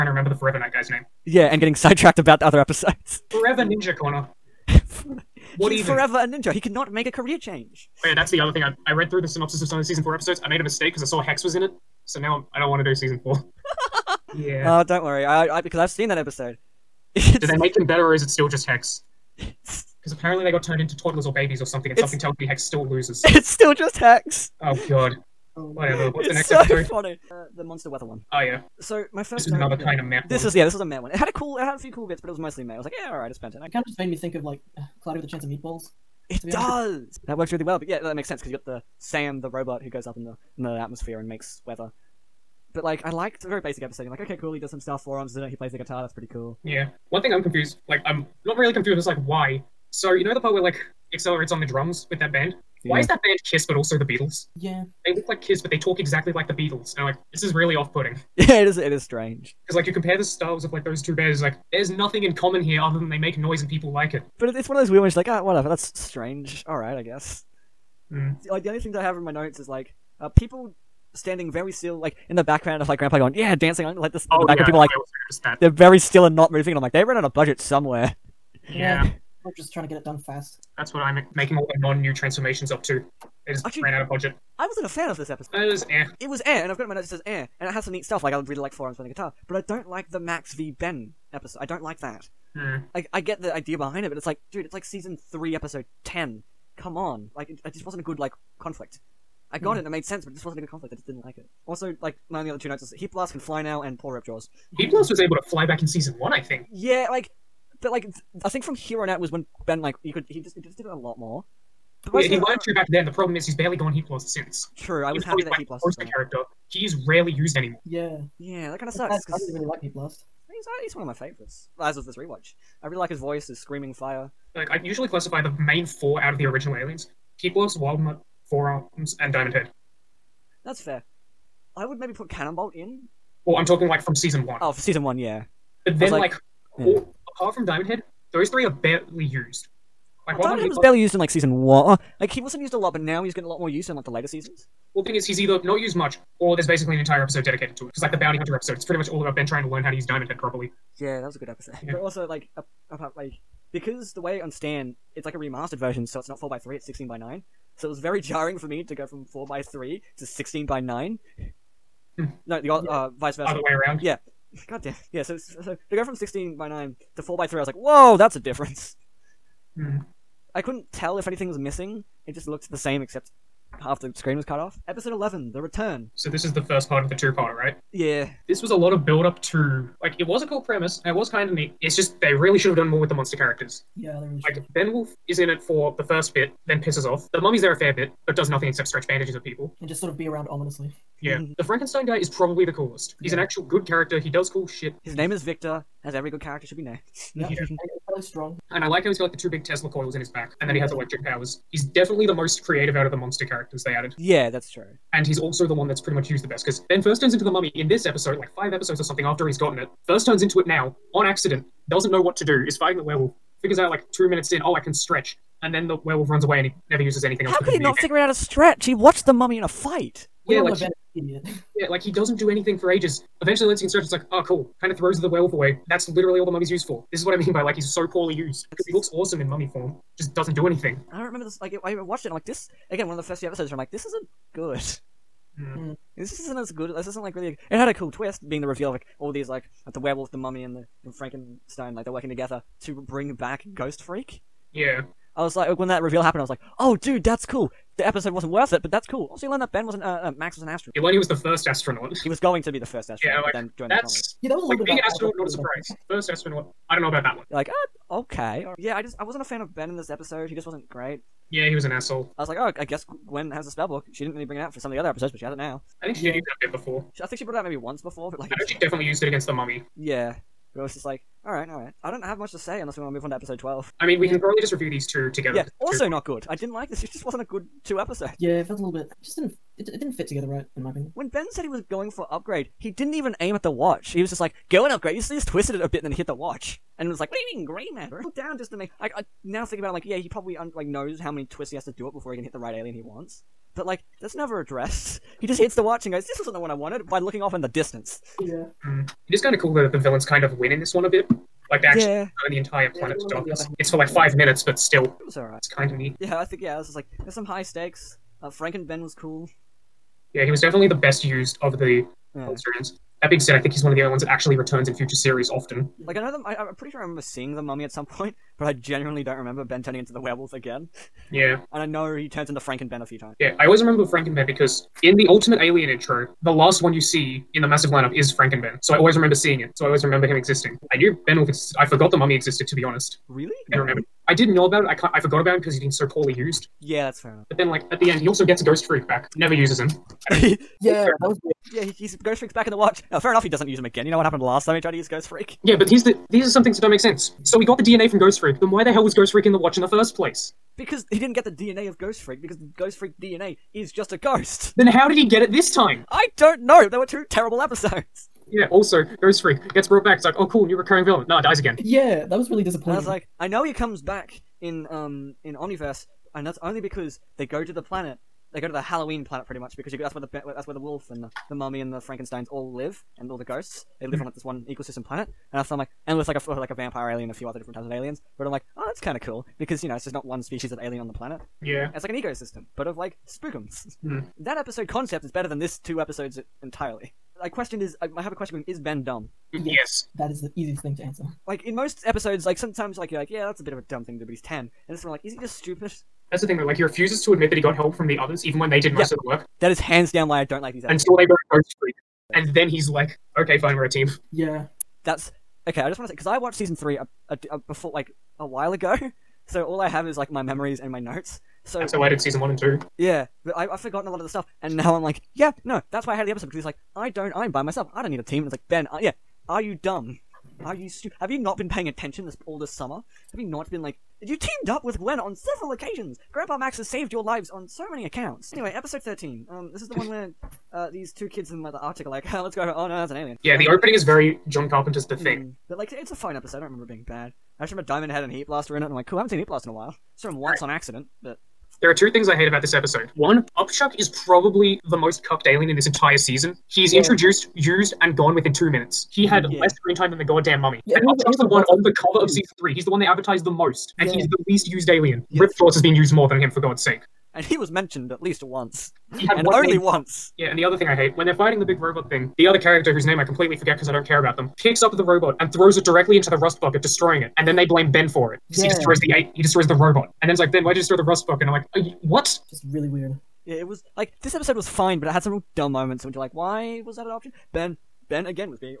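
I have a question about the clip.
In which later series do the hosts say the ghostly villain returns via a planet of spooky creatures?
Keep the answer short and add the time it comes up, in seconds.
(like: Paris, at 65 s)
Omniverse, at 365 s.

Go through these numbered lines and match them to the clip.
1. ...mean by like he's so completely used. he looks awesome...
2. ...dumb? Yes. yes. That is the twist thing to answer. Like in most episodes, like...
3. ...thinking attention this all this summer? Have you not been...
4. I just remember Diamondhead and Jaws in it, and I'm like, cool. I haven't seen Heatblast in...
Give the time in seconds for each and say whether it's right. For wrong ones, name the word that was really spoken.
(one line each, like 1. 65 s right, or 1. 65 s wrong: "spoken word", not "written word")
1. 227 s wrong: "poorly", not "completely"
2. 389 s wrong: "easiest", not "twist"
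3. 421 s wrong: "paying", not "thinking"
4. 437 s wrong: "Heatblast", not "Jaws".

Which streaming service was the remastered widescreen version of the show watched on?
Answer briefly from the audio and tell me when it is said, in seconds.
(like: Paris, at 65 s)
Stan, at 154 s.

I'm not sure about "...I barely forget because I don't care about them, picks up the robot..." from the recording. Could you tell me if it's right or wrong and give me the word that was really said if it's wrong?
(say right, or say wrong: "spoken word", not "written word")
wrong: "completely", not "barely".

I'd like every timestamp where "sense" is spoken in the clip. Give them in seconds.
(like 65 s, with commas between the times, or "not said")
38 s, 100 s, 346 s.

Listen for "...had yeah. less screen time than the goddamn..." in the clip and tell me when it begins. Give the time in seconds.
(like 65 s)
449 s.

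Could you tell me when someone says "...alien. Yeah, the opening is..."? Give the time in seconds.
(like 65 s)
433 s.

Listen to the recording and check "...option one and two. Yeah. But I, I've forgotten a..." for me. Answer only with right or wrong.
wrong.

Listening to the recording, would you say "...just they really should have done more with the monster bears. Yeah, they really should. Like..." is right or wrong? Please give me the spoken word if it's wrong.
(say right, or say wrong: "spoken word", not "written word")
wrong: "characters", not "bears".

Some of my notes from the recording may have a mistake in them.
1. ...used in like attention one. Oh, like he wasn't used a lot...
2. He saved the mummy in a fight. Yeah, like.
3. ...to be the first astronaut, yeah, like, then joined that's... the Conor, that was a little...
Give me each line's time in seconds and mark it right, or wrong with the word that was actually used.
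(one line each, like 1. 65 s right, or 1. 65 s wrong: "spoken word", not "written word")
1. 141 s wrong: "season", not "attention"
2. 218 s wrong: "watched", not "saved"
3. 252 s wrong: "Yeah", not "Conor".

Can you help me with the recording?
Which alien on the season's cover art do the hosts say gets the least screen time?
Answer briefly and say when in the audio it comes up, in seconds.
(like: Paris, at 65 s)
Upchuck, at 443 s.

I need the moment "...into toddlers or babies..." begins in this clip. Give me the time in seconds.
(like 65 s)
20 s.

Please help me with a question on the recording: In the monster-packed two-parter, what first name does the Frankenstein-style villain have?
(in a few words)
Victor.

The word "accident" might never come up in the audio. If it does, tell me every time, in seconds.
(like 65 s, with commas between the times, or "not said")
211 s, 440 s.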